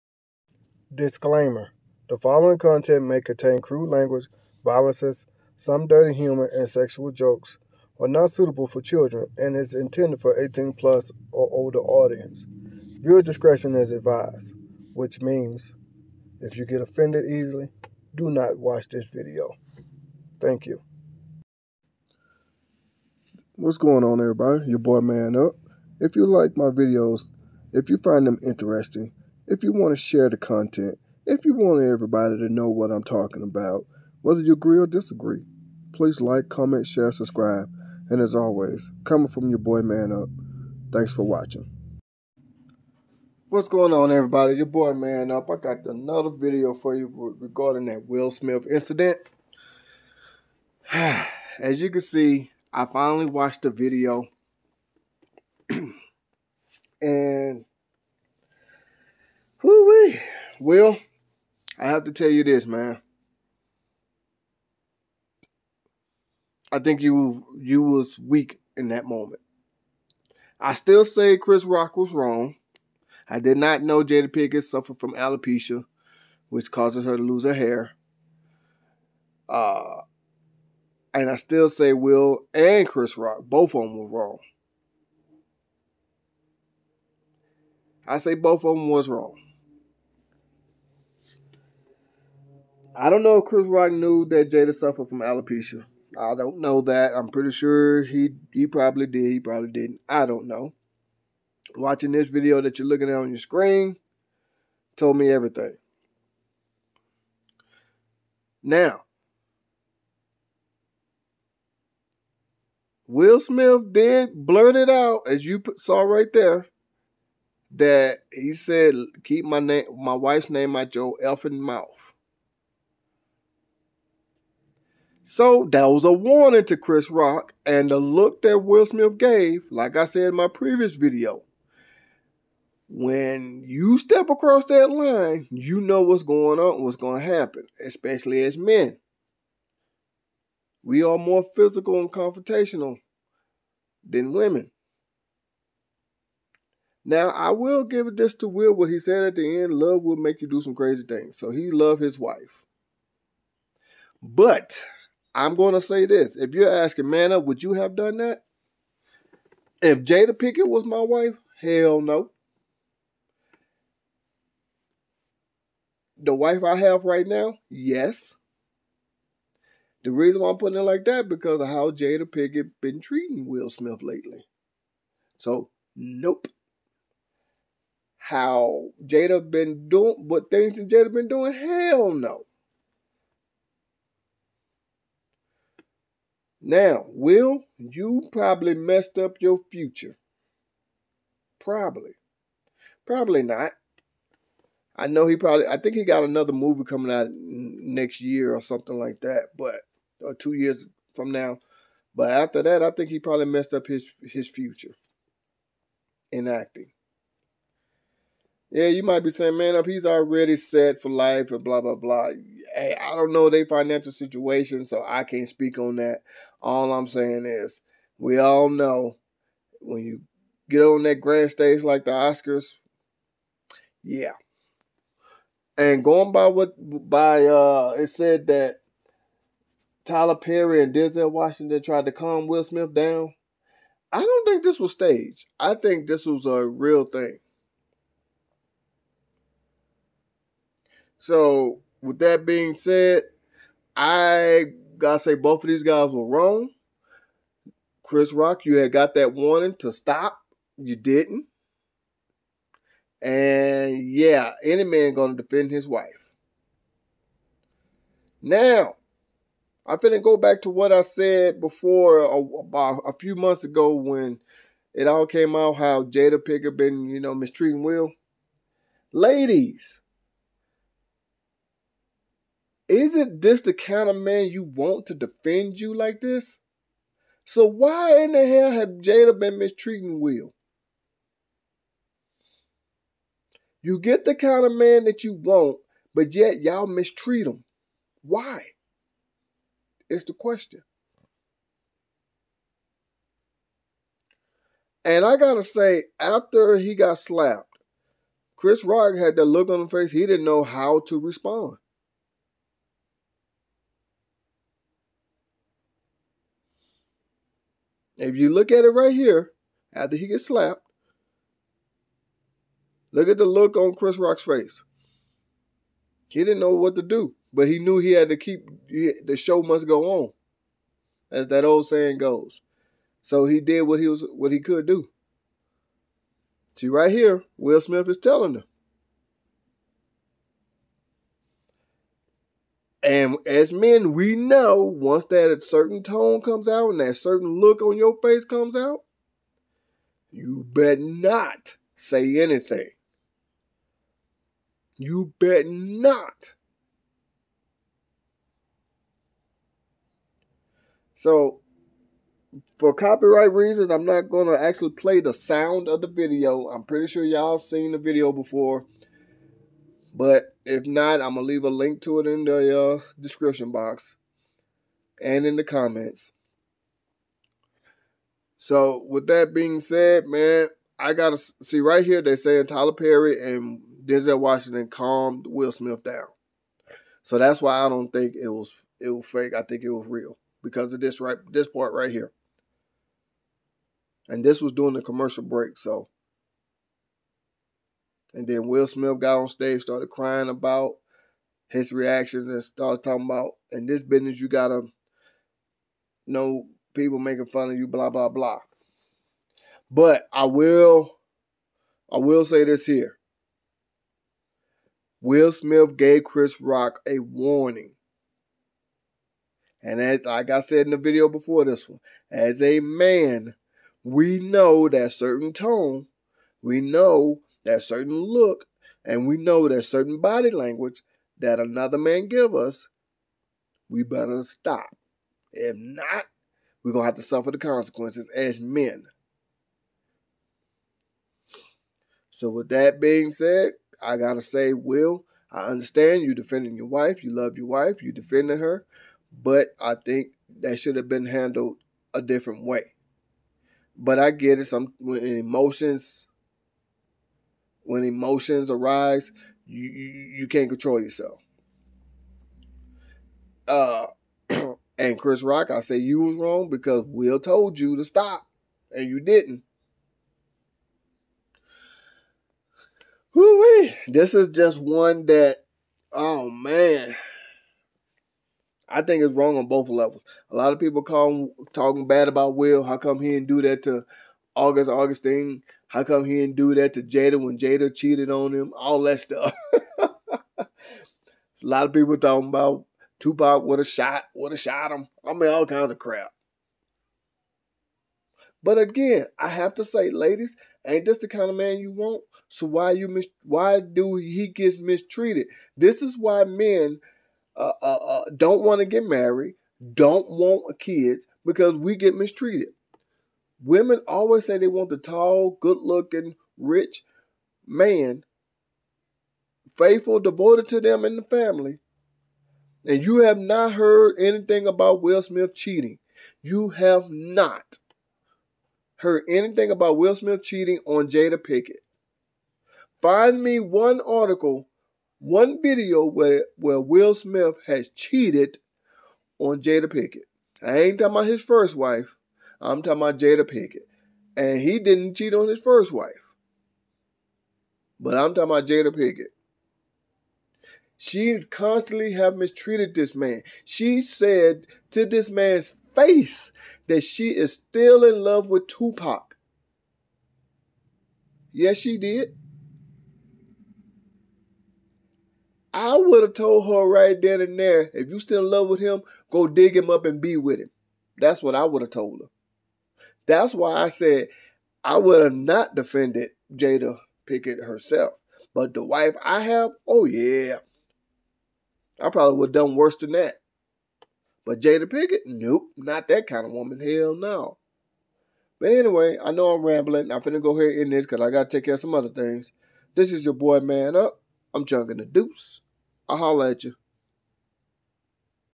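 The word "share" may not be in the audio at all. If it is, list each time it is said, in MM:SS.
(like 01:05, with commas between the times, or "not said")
00:30, 00:36.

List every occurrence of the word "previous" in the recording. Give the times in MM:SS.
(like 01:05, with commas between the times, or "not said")
02:10.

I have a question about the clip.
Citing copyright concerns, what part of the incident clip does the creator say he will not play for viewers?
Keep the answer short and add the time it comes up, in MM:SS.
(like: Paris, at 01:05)
The sound, at 05:55.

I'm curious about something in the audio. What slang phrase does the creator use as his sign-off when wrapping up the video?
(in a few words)
Chunking the deuce.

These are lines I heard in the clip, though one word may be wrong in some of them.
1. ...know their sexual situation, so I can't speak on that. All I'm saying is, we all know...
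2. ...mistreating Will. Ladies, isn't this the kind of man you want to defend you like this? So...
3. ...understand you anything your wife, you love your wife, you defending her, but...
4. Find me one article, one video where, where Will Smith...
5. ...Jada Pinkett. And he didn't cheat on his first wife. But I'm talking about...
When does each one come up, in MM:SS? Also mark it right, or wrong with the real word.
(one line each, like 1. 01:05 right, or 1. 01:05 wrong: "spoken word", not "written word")
1. 03:33 wrong: "financial", not "sexual"
2. 04:27 right
3. 07:15 wrong: "defending", not "anything"
4. 08:43 right
5. 08:53 right.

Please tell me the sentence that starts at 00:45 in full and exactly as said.
I got another video for you regarding that Will Smith incident.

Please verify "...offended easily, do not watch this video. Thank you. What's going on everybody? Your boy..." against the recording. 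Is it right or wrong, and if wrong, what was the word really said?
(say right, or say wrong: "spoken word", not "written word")
right.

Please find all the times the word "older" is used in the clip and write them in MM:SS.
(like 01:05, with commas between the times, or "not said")
00:11.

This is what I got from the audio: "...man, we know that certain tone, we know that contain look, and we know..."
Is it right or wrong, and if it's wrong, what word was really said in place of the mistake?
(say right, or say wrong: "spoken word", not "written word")
wrong: "certain", not "contain".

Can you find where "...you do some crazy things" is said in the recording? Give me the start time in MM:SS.
02:30.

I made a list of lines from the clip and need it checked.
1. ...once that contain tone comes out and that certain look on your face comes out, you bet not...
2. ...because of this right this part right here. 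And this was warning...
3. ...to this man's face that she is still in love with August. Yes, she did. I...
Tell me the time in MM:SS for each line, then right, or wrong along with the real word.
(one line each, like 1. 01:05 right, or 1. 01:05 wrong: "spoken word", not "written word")
1. 05:34 wrong: "certain", not "contain"
2. 06:20 wrong: "during", not "warning"
3. 09:04 wrong: "Tupac", not "August".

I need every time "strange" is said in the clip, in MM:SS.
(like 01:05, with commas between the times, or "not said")
not said.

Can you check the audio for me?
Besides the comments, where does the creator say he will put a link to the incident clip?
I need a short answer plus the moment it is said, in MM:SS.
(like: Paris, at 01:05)
Description box, at 06:03.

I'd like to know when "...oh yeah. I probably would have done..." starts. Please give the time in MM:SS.
09:29.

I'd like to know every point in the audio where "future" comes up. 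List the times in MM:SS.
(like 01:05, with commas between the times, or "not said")
03:09, 03:24.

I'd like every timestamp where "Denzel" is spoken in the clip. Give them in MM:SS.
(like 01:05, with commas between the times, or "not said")
03:50, 06:14.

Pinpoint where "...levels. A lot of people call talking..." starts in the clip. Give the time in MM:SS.
07:49.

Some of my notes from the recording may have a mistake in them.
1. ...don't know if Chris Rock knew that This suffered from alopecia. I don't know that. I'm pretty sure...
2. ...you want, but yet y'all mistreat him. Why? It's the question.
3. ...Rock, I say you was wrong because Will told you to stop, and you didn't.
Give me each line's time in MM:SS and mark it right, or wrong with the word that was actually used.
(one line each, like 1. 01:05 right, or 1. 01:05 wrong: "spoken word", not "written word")
1. 01:33 wrong: "Jada", not "This"
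2. 04:45 right
3. 07:35 right.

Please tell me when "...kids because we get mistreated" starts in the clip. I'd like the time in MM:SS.
08:20.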